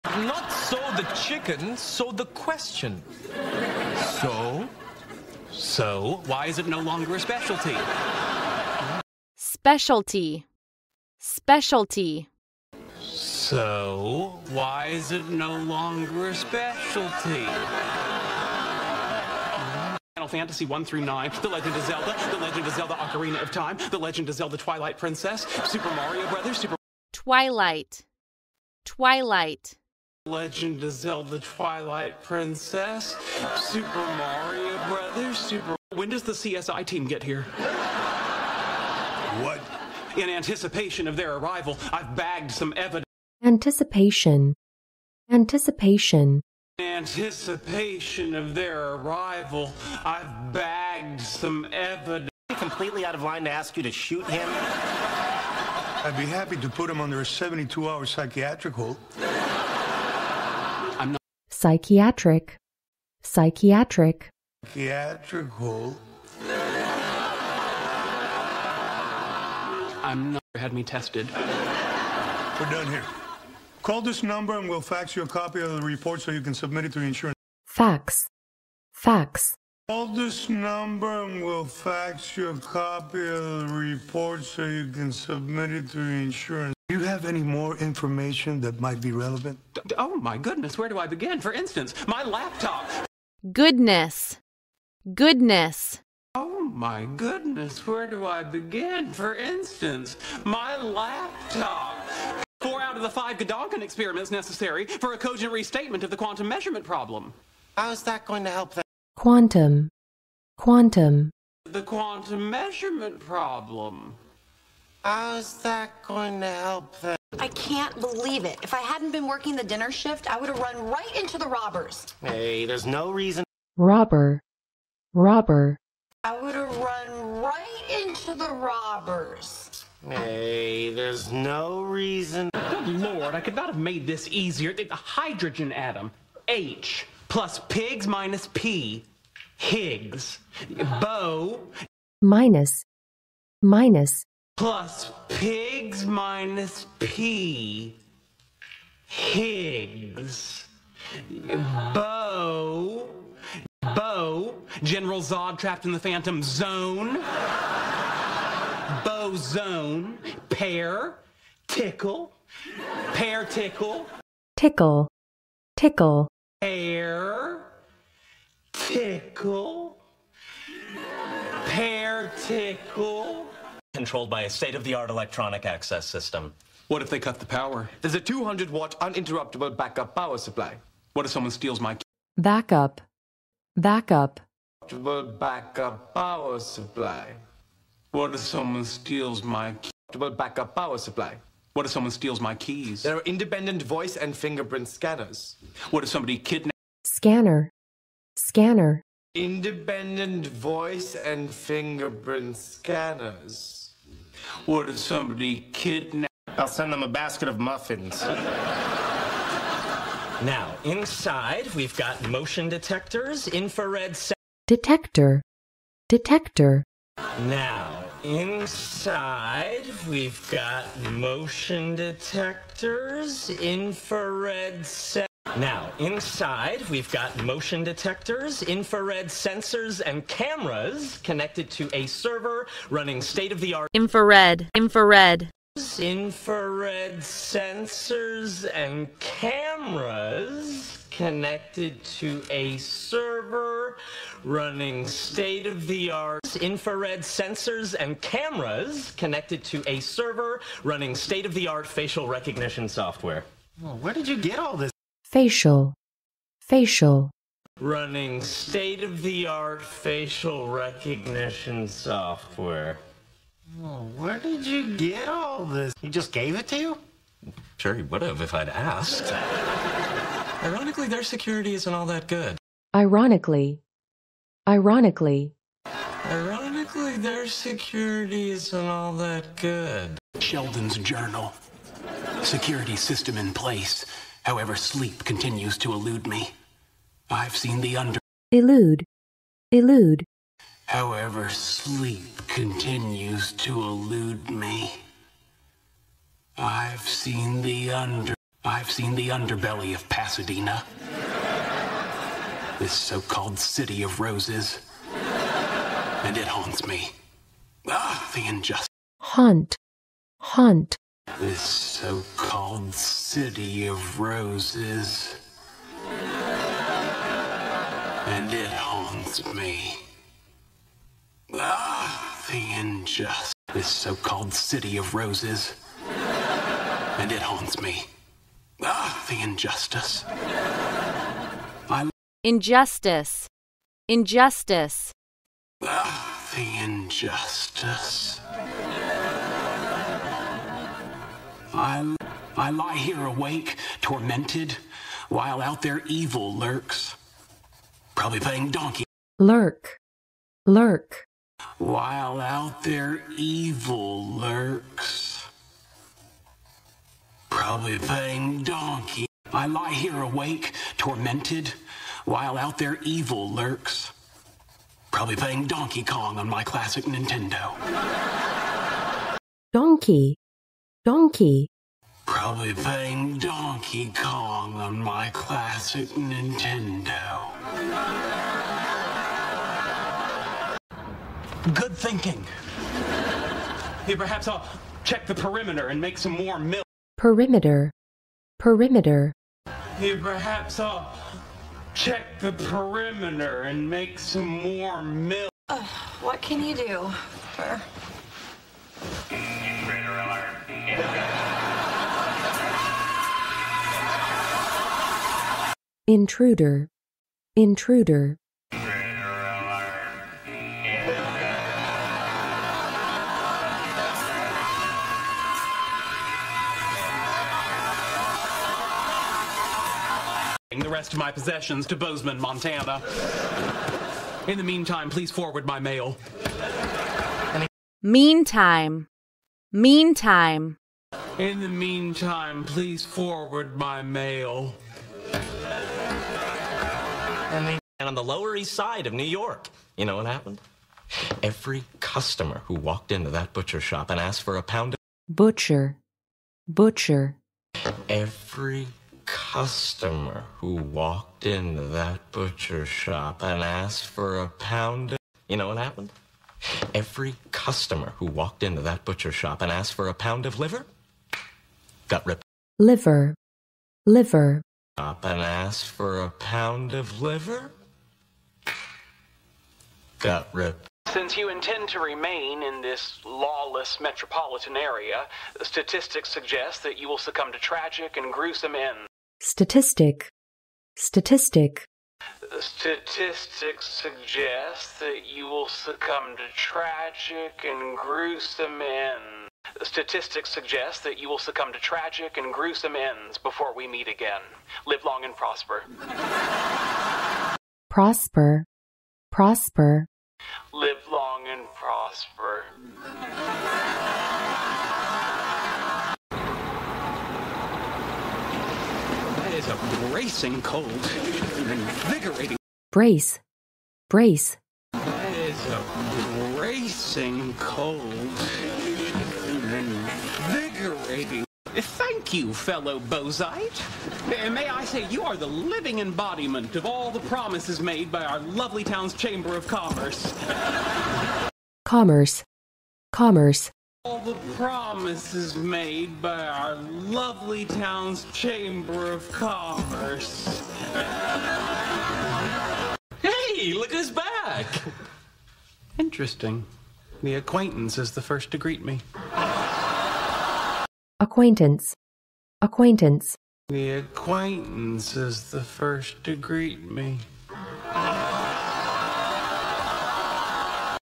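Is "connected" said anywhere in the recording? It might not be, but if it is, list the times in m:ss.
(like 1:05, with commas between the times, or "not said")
3:51, 4:01, 4:09.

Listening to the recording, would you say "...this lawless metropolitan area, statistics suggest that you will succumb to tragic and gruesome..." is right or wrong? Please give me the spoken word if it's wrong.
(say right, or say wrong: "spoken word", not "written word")
right.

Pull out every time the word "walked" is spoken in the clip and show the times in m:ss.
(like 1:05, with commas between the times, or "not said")
7:22, 7:30, 7:38.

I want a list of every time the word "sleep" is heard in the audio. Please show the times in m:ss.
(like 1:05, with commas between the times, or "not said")
4:44, 4:51.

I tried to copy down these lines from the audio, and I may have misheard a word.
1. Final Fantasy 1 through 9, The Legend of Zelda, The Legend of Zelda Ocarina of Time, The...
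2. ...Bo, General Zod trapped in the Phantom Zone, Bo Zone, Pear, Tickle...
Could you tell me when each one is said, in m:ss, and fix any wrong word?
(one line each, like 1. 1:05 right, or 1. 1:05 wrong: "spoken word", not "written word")
1. 0:20 right
2. 2:33 right.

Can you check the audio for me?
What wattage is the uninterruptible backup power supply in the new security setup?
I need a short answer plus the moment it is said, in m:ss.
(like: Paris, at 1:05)
200-watt, at 2:58.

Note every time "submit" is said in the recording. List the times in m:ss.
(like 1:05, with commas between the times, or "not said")
1:16, 1:25.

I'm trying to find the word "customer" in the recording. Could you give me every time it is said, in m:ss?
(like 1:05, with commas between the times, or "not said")
7:21, 7:29, 7:37.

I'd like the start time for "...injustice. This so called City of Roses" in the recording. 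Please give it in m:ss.
5:22.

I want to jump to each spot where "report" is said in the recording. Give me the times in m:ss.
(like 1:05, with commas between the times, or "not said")
1:15, 1:23.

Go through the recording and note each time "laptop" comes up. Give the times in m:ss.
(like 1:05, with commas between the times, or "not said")
1:32, 1:40.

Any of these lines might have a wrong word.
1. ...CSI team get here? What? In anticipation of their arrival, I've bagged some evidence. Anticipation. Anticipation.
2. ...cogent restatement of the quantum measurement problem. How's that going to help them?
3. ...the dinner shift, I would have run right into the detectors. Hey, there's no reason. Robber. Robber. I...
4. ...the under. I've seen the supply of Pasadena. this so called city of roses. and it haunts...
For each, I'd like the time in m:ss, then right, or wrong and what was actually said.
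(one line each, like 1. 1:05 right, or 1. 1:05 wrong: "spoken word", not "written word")
1. 0:36 right
2. 1:45 right
3. 1:59 wrong: "robbers", not "detectors"
4. 4:57 wrong: "underbelly", not "supply".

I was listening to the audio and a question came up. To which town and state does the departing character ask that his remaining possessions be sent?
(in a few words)
Bozeman, Montana.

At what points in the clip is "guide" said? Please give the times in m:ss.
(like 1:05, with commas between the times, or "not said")
not said.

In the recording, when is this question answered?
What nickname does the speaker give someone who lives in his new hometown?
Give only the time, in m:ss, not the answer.
8:42.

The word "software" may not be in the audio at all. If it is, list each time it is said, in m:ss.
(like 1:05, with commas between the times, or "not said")
4:12, 4:21.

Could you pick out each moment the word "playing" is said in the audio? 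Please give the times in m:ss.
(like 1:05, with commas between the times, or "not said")
5:48, 5:57, 6:05, 6:12.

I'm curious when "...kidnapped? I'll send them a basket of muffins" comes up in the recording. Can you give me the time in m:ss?
3:25.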